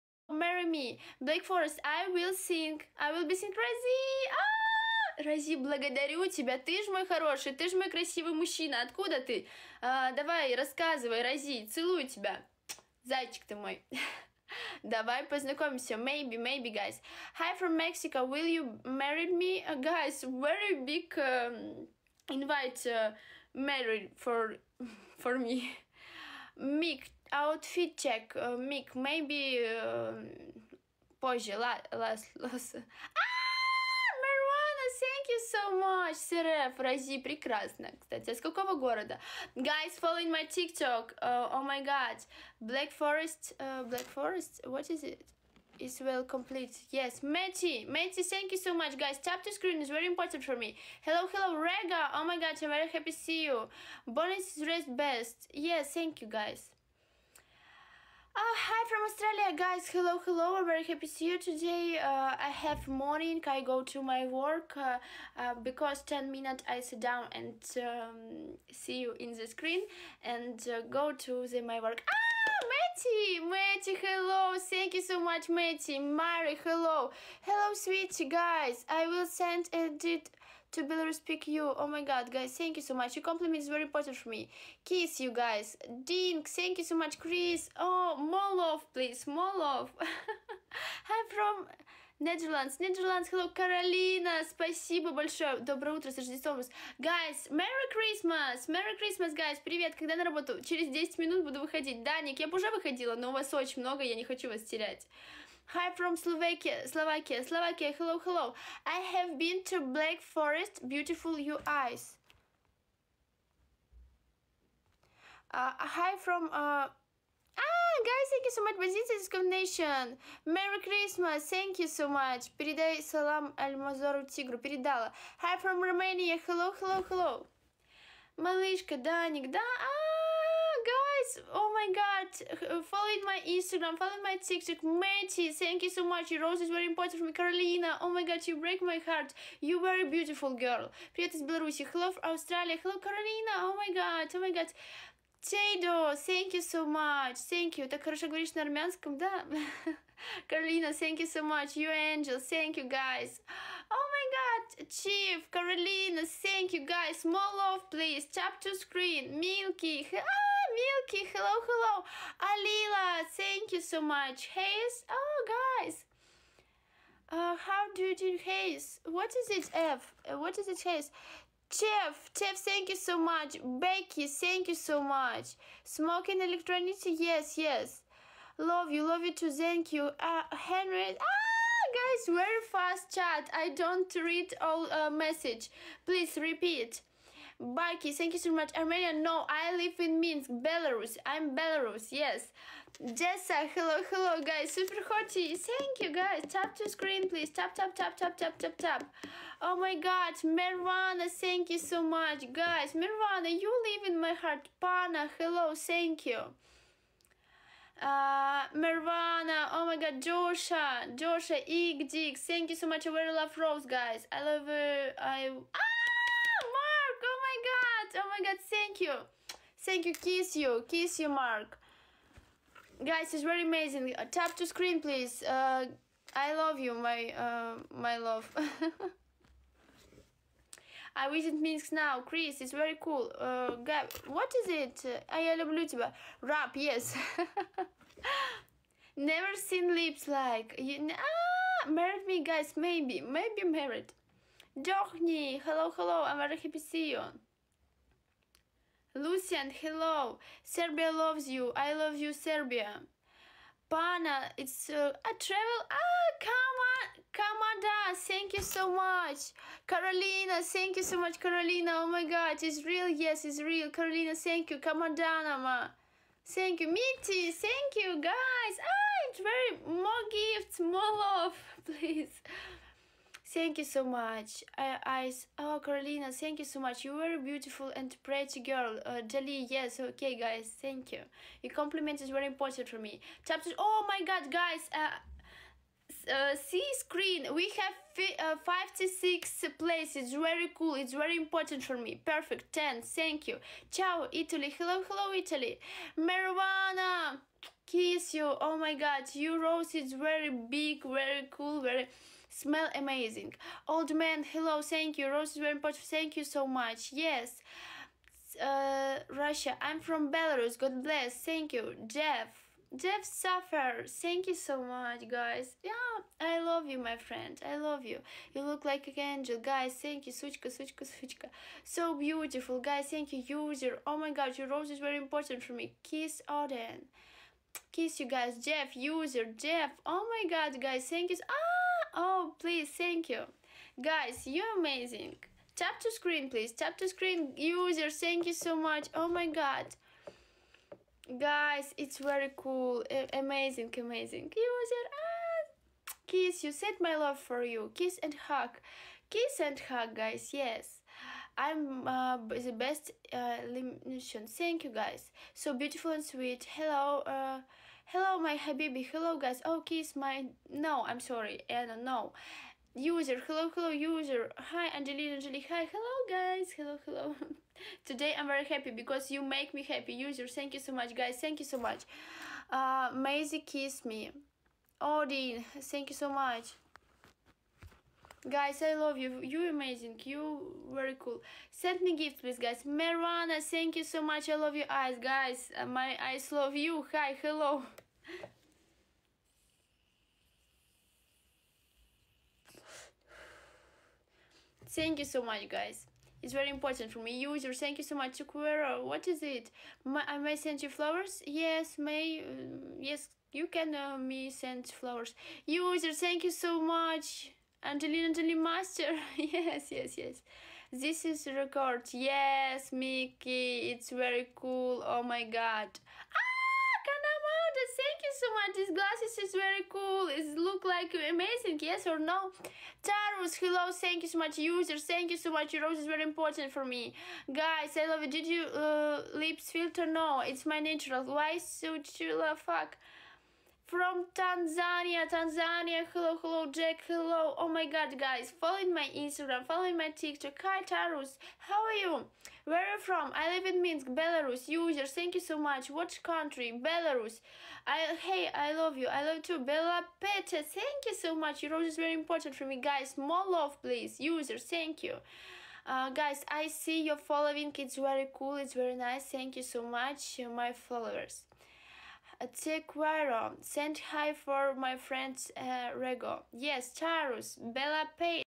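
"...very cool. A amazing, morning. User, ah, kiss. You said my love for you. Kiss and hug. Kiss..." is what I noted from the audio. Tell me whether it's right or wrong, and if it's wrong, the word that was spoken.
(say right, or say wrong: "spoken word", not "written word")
wrong: "amazing", not "morning".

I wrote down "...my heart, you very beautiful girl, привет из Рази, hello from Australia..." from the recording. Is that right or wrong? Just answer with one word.
wrong.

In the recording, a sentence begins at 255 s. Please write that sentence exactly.
Ah, on Kamada, thank you so much.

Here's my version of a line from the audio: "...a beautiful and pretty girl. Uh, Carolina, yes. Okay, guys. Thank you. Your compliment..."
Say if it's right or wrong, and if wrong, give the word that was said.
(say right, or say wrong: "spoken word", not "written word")
wrong: "Jali", not "Carolina".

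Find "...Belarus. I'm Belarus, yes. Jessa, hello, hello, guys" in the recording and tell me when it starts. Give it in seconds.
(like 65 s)
190 s.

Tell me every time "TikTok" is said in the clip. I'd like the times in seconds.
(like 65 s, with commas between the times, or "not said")
40 s, 134 s, 440 s.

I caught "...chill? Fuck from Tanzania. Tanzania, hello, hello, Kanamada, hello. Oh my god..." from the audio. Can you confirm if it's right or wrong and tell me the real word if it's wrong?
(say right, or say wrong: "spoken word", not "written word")
wrong: "Jack", not "Kanamada".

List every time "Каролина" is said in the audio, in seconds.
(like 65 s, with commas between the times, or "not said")
93 s, 150 s.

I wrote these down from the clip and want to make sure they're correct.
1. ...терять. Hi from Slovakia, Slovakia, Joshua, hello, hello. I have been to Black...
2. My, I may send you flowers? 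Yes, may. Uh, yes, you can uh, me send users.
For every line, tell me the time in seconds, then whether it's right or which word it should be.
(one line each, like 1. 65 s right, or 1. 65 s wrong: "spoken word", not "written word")
1. 104 s wrong: "Slovakia", not "Joshua"
2. 400 s wrong: "flowers", not "users".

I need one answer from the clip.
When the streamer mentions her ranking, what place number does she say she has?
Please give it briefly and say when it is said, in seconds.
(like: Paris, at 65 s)
56, at 288 s.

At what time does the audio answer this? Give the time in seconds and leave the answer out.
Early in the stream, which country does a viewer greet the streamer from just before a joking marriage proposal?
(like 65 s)
17 s.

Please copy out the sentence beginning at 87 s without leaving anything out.
Oh, more love, please, more love.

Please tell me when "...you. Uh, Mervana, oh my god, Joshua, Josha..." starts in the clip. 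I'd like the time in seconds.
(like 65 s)
206 s.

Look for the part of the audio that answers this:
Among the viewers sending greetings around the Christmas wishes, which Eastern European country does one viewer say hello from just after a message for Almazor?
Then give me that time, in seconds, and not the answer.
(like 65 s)
125 s.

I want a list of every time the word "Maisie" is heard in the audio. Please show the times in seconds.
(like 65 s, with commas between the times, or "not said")
373 s.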